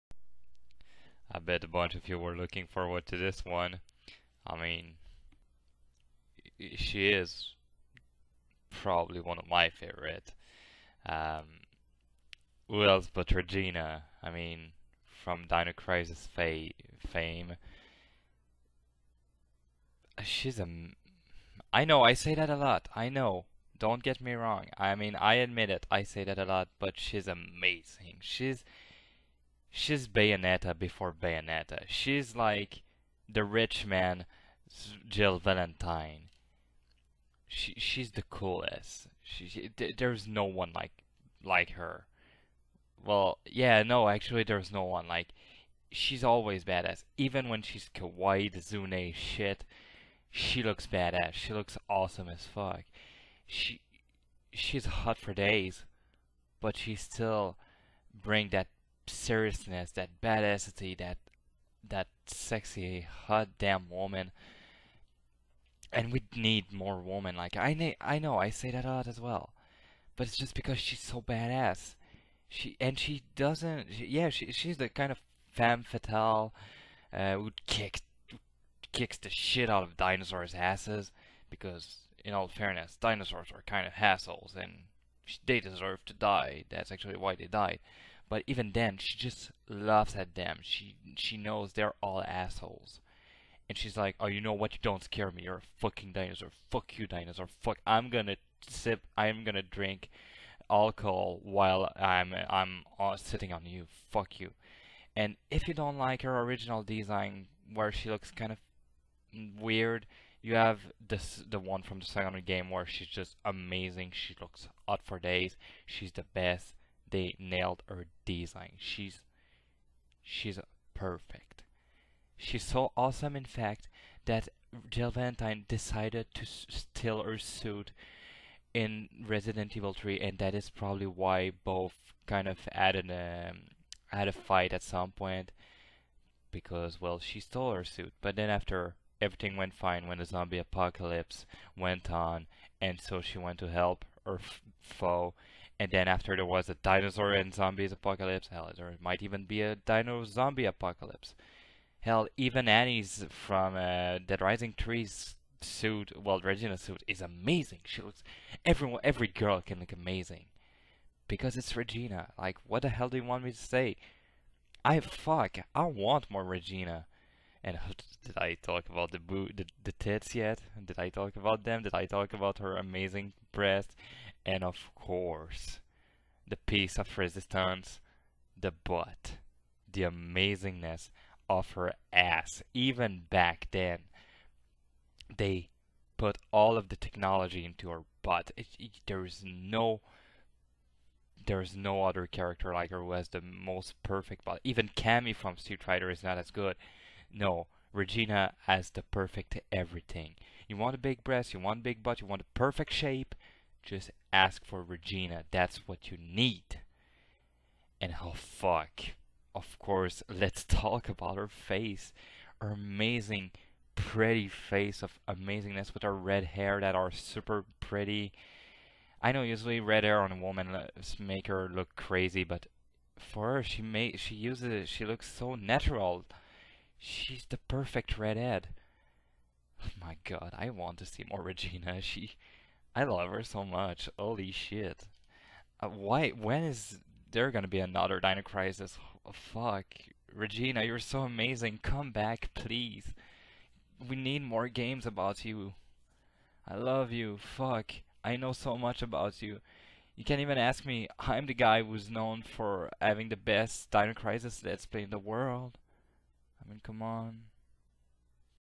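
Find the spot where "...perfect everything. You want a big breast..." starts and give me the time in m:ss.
3:19.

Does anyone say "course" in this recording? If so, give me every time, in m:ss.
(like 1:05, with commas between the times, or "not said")
2:54, 3:29.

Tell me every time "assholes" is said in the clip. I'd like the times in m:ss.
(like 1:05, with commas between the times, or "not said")
1:23, 1:32.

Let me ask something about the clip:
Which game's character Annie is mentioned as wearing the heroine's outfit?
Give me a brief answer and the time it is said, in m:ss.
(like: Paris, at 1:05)
Dead Rising 3, at 2:34.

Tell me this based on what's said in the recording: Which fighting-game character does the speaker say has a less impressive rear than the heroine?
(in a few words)
Cammy.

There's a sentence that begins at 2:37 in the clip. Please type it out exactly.
She looks, everyone, every girl can look amazing.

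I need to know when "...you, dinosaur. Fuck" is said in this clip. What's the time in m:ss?
1:36.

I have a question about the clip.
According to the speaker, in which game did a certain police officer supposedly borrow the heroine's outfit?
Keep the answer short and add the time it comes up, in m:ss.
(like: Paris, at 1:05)
Resident Evil 3, at 2:09.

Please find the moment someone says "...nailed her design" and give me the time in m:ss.
1:57.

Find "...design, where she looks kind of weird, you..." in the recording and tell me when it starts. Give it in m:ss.
1:46.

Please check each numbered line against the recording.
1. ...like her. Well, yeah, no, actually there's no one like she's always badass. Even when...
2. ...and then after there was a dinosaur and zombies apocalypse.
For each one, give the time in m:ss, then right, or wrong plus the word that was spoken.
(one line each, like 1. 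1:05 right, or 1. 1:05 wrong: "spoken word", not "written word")
1. 0:41 right
2. 2:25 right.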